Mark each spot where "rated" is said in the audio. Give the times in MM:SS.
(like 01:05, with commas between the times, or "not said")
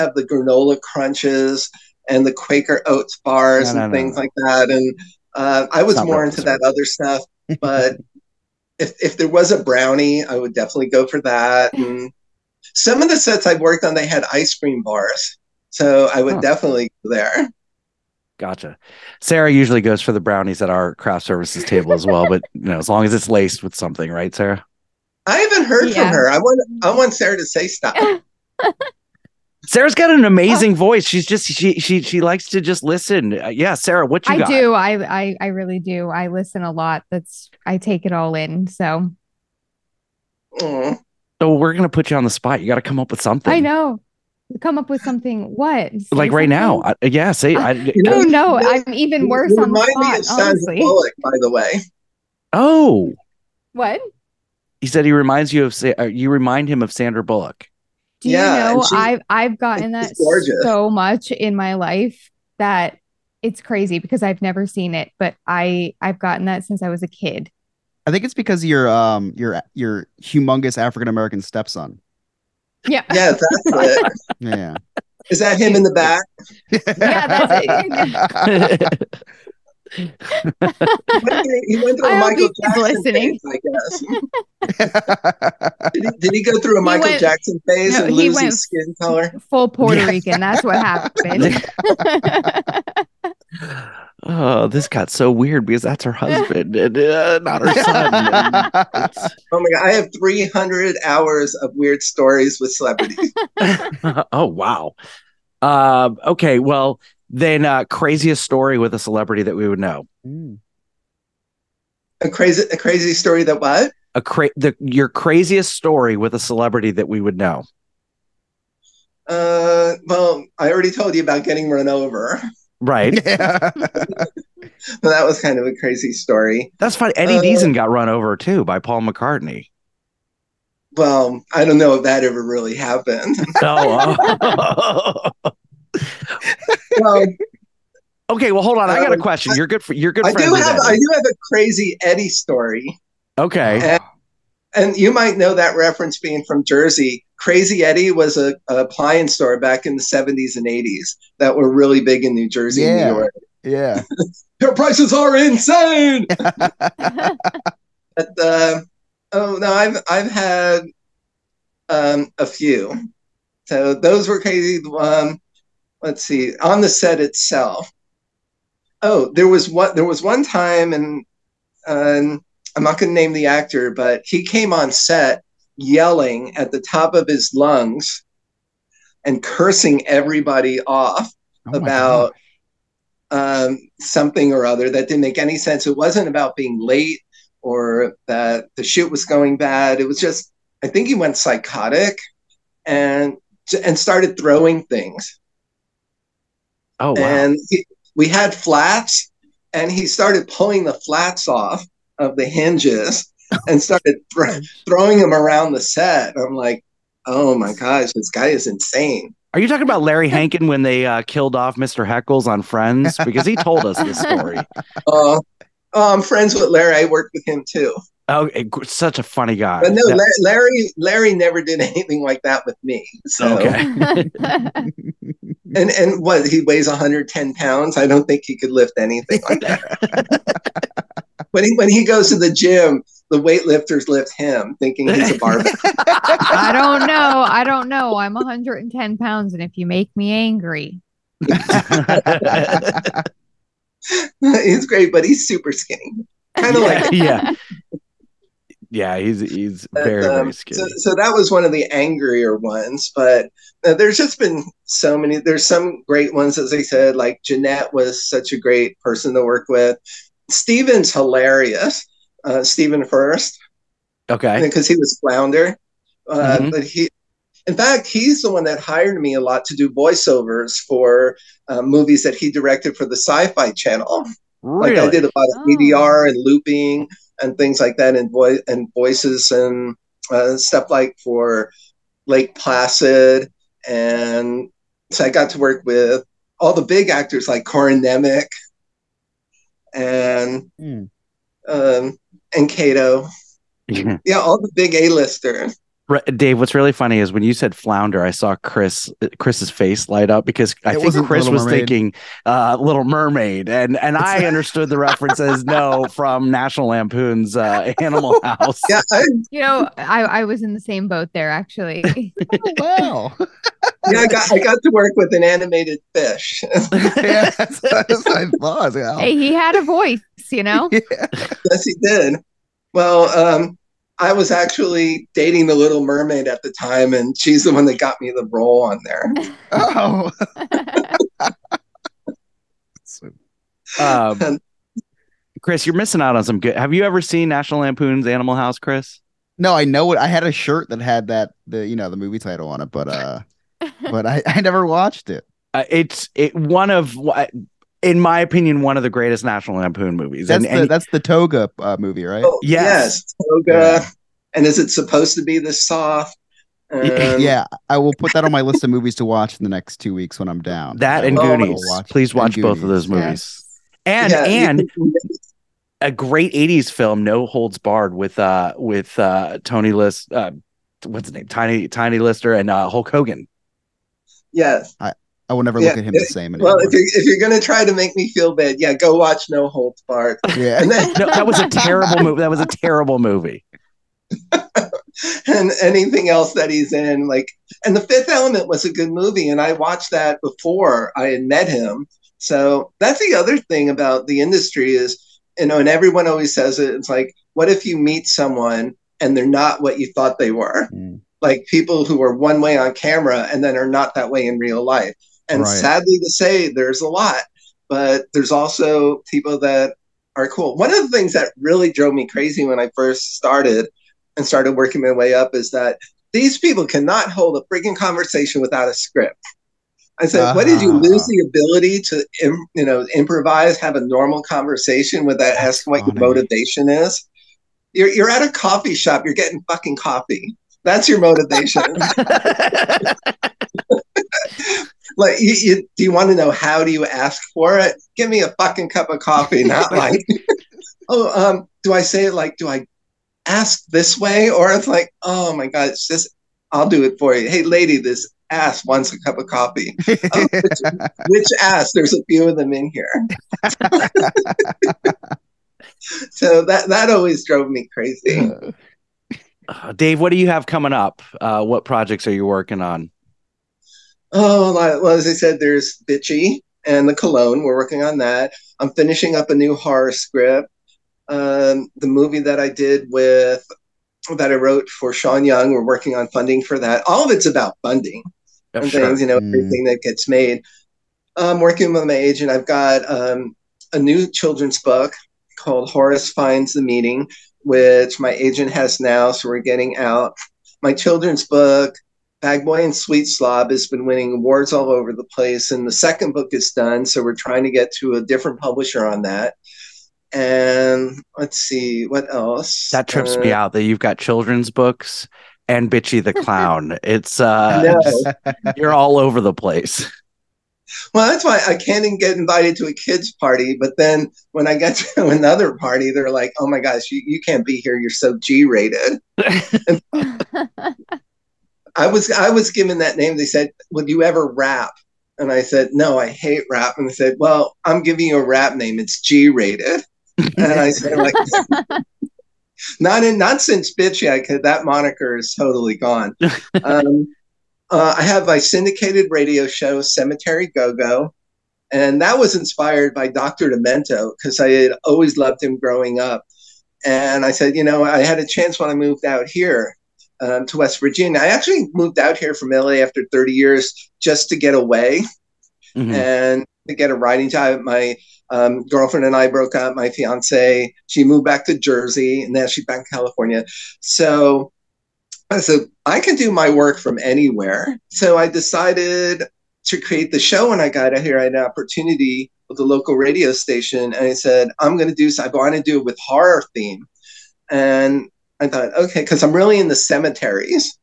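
08:38, 08:49.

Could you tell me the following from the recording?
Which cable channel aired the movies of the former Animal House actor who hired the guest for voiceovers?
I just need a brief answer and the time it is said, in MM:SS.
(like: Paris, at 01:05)
Sci Fi Channel, at 04:33.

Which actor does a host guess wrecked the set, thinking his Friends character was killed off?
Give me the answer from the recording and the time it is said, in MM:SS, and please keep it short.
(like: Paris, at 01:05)
Larry Hankin, at 03:30.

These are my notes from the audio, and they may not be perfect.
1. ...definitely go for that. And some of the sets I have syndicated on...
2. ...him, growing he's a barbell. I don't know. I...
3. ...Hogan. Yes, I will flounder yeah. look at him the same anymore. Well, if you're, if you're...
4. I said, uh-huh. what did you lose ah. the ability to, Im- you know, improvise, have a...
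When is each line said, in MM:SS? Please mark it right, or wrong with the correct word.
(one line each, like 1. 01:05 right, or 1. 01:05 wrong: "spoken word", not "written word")
1. 00:10 wrong: "worked", not "syndicated"
2. 03:54 wrong: "thinking", not "growing"
3. 06:13 wrong: "never", not "flounder"
4. 07:00 right.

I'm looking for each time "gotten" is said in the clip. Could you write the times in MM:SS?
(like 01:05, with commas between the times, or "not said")
00:59, 01:06.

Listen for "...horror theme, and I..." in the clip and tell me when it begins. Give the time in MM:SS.
09:36.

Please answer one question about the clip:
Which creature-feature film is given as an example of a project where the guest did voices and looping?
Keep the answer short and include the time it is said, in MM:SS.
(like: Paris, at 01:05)
Lake Placid, at 04:42.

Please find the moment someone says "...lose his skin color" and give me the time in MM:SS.
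01:28.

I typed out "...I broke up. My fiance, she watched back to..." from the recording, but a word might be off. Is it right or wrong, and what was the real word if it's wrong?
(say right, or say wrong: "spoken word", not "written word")
wrong: "moved", not "watched".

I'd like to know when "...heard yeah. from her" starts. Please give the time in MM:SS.
00:25.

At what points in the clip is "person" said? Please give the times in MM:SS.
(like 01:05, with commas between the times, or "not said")
04:19.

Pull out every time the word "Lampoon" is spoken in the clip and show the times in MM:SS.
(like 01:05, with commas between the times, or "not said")
05:06, 05:37, 05:49.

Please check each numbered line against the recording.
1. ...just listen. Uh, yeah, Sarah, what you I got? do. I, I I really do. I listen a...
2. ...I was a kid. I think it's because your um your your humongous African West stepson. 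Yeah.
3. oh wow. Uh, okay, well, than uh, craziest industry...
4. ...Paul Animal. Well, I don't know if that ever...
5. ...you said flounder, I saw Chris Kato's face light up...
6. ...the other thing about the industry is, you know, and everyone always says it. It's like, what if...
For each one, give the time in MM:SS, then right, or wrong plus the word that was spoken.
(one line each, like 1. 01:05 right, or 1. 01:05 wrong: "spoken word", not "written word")
1. 00:32 right
2. 01:06 wrong: "American", not "West"
3. 01:44 wrong: "story", not "industry"
4. 02:08 wrong: "McCartney", not "Animal"
5. 04:57 wrong: "Chris", not "Kato"
6. 06:33 right.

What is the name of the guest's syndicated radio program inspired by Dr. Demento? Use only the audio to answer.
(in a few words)
Cemetery Go Go.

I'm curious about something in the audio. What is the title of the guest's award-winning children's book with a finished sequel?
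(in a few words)
Bag Boy and Sweet Slob.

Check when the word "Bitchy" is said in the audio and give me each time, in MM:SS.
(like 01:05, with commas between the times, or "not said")
07:46, 08:25, 08:53.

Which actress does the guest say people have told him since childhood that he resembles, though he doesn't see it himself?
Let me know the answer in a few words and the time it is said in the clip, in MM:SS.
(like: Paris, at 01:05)
Sandra Bullock, at 00:56.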